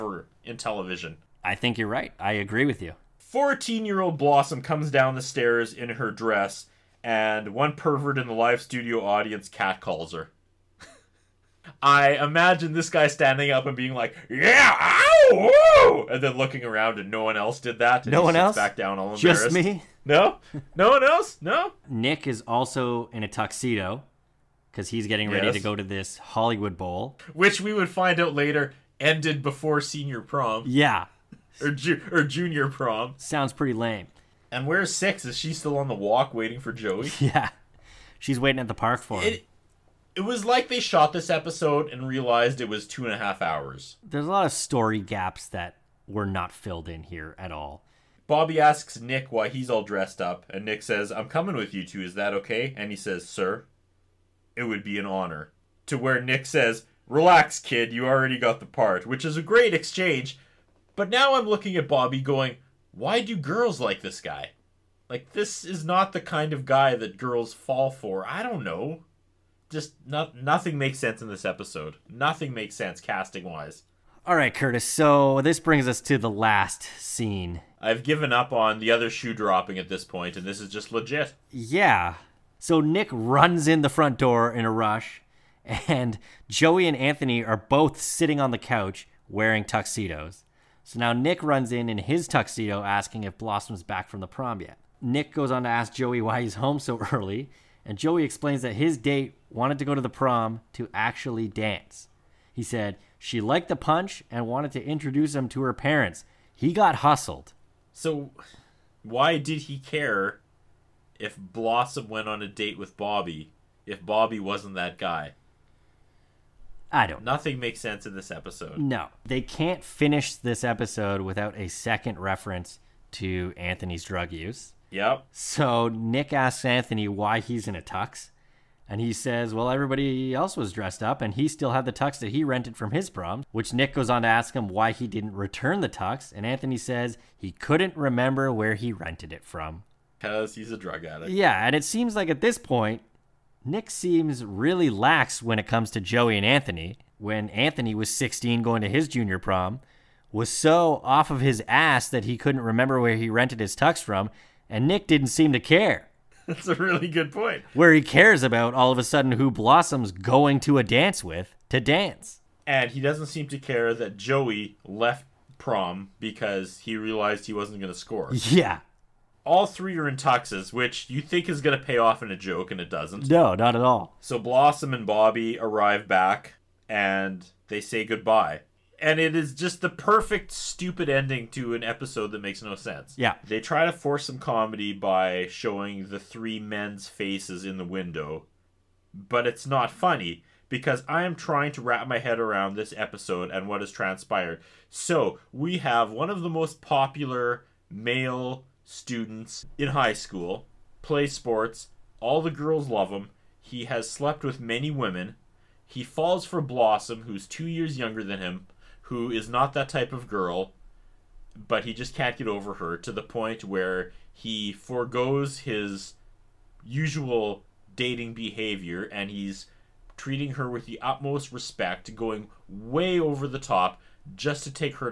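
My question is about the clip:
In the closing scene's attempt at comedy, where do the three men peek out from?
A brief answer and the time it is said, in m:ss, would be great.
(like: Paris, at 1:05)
the window, at 3:07.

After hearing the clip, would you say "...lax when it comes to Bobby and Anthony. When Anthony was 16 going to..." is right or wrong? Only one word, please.
wrong.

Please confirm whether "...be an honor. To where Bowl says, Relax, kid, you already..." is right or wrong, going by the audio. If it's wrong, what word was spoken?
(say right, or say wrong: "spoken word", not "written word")
wrong: "Nick", not "Bowl".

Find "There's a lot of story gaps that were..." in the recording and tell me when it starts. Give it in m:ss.
0:44.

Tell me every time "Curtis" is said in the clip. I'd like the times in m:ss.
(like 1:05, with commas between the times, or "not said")
1:14.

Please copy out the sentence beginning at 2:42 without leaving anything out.
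And he doesn't seem to care that Joey left prom because he realized he wasn't going to score.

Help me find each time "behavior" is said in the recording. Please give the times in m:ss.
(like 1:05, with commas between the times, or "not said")
3:38.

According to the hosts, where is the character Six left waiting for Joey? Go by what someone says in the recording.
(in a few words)
the park.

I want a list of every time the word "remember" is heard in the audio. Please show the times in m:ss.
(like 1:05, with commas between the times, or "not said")
2:17, 2:32.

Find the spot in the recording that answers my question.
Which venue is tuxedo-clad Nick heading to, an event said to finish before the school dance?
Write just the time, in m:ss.
0:26.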